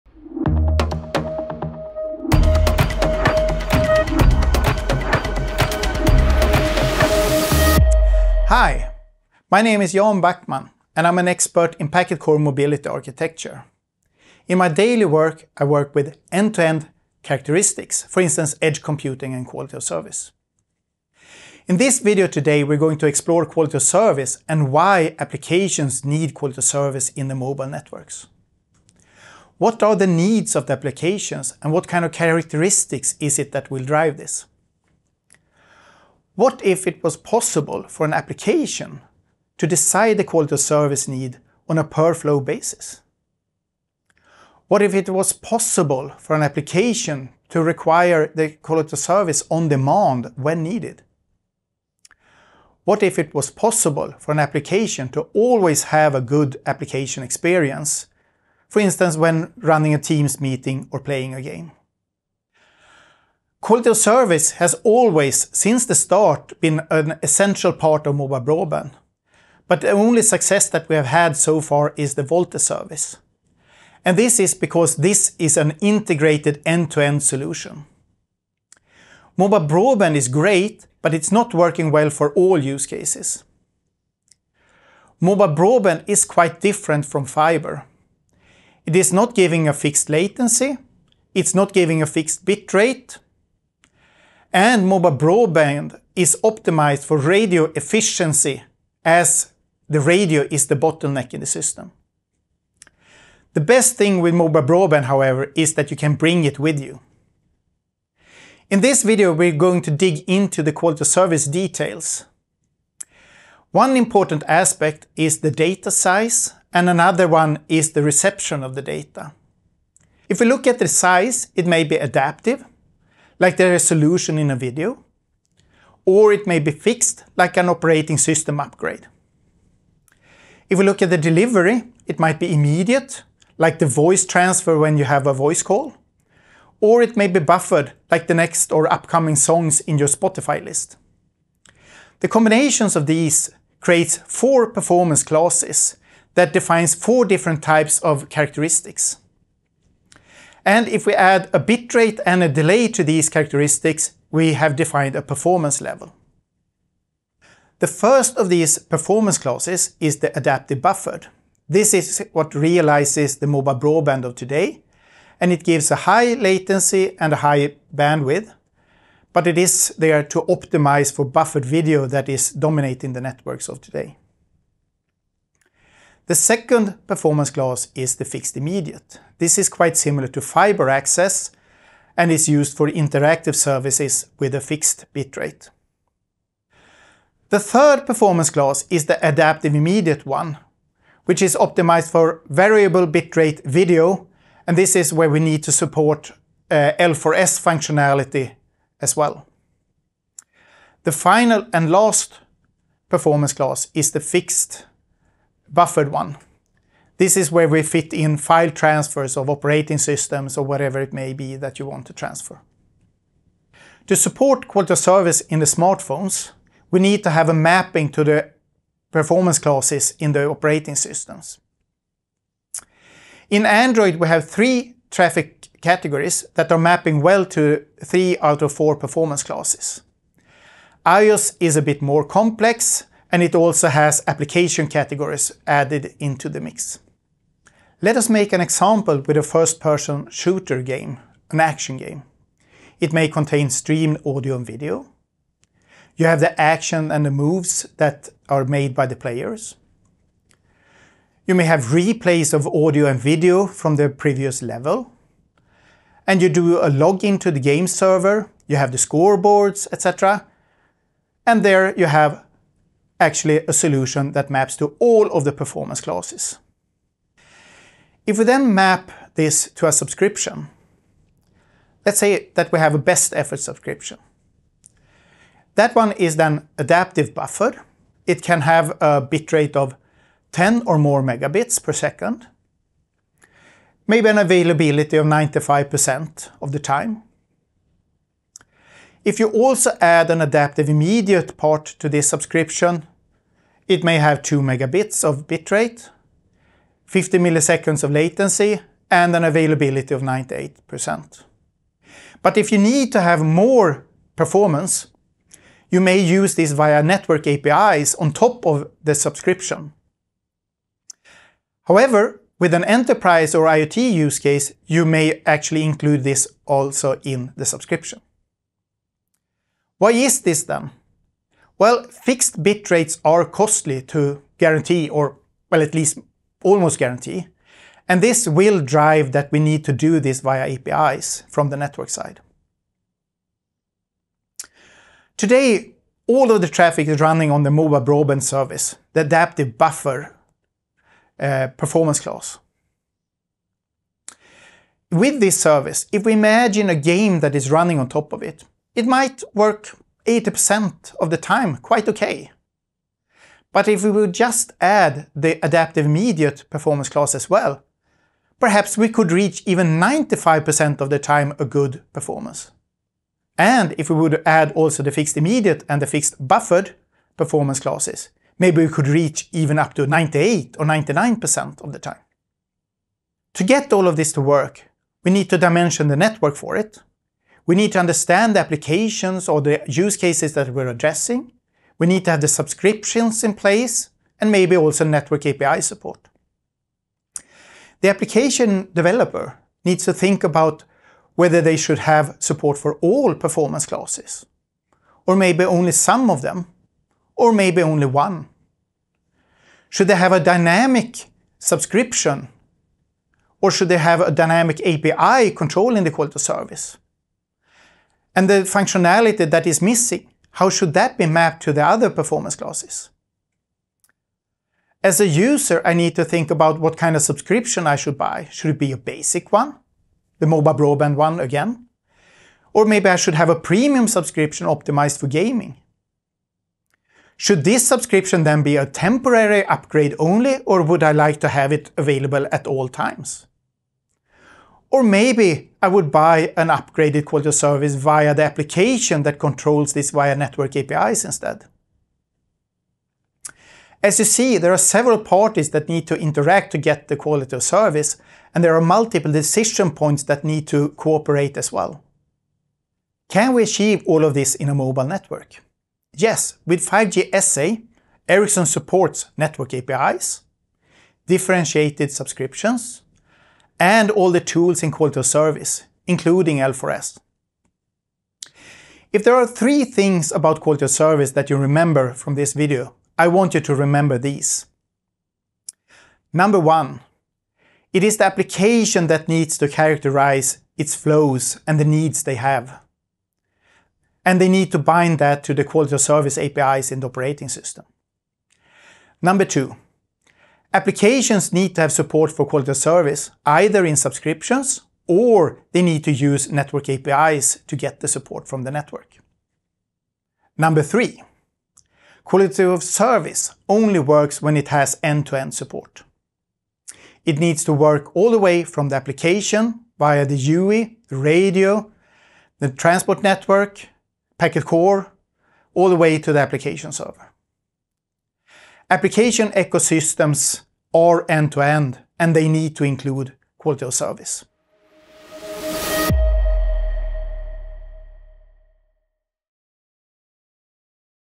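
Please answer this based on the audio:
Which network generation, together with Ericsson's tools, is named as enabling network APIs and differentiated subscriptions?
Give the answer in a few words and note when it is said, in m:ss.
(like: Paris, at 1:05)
5G SA, at 7:36.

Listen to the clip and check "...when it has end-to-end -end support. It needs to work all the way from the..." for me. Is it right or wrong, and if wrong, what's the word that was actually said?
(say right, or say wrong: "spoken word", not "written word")
right.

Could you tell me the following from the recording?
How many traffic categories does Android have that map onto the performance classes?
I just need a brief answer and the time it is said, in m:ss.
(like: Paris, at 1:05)
3, at 3:44.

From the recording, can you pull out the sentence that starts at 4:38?
It can have a bitrate of 10 or more megabits per second, maybe an availability of 95% of the time.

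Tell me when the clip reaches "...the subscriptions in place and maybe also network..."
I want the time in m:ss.
6:22.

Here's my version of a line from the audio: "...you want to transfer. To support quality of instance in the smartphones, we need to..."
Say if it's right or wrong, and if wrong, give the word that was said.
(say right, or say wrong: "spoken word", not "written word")
wrong: "service", not "instance".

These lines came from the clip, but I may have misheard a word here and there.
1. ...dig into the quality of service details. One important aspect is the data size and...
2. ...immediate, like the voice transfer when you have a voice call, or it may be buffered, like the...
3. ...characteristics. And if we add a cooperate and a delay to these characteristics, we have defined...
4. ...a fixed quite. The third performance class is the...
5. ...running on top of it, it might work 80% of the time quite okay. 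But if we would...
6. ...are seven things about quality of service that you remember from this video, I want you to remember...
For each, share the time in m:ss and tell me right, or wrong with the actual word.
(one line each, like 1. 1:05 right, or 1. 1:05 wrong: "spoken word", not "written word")
1. 1:49 right
2. 2:12 right
3. 2:28 wrong: "bitrate", not "cooperate"
4. 3:04 wrong: "bitrate", not "quite"
5. 5:47 right
6. 7:49 wrong: "three", not "seven".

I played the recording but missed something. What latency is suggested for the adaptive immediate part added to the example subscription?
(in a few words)
50 milliseconds.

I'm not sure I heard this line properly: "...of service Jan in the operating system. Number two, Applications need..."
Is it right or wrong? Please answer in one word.
wrong.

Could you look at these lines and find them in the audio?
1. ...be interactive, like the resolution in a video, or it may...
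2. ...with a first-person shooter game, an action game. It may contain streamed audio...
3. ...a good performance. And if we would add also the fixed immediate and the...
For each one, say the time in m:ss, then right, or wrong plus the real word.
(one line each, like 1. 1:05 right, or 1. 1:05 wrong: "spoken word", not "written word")
1. 2:01 wrong: "adaptive", not "interactive"
2. 3:59 right
3. 6:01 right.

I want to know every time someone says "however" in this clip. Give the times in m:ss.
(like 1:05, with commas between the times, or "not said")
1:45, 5:11.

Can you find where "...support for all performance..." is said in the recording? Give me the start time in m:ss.
6:32.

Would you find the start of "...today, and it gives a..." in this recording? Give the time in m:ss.
2:44.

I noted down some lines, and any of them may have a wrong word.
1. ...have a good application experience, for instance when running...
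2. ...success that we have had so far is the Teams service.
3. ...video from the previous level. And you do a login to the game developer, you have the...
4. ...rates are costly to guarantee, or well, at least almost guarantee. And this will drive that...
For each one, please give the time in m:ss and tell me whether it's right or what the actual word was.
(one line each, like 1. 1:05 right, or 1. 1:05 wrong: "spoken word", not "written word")
1. 0:55 right
2. 1:10 wrong: "VoLTE", not "Teams"
3. 4:13 wrong: "server", not "developer"
4. 5:22 right.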